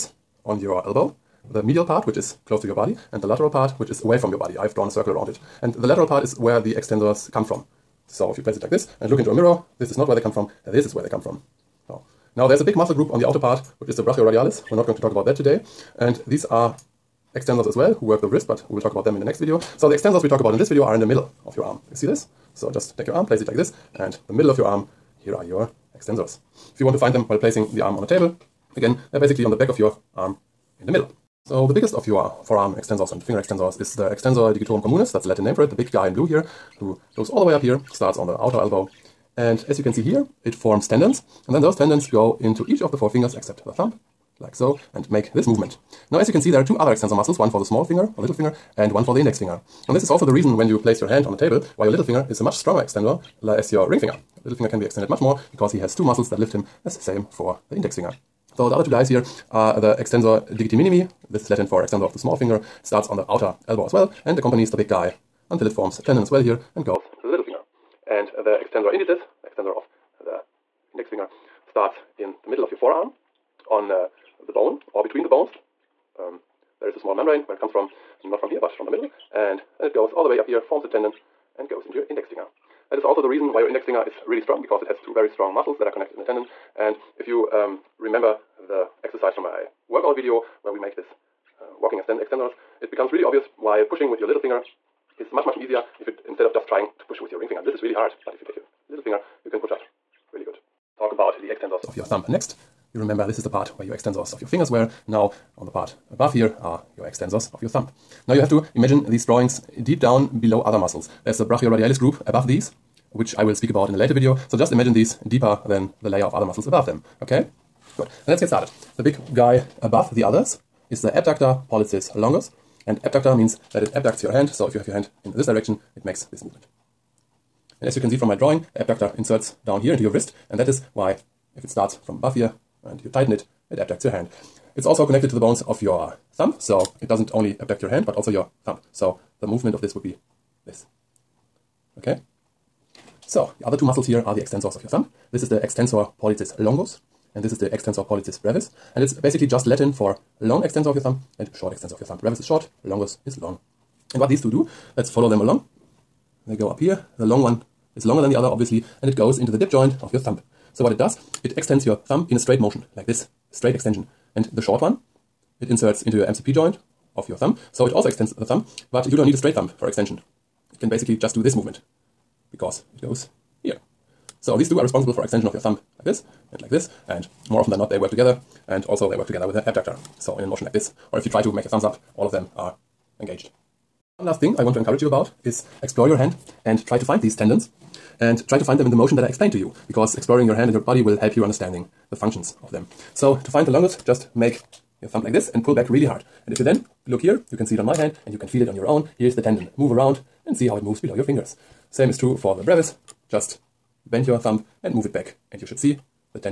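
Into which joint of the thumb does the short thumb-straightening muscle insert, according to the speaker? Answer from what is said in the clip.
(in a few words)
MCP joint.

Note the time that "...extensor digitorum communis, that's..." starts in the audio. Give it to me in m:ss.
0:34.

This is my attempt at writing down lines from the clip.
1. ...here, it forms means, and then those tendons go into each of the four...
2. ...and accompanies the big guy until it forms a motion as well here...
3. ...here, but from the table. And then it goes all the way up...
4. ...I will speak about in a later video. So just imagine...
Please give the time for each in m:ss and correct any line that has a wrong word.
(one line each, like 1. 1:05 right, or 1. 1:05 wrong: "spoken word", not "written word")
1. 0:40 wrong: "tendons", not "means"
2. 1:04 wrong: "tendon", not "motion"
3. 1:18 wrong: "middle", not "table"
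4. 1:53 right.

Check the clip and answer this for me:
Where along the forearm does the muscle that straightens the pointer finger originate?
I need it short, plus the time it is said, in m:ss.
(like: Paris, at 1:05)
the middle of your forearm, at 1:12.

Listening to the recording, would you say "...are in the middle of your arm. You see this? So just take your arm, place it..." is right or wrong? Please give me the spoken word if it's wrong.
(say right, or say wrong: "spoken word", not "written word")
right.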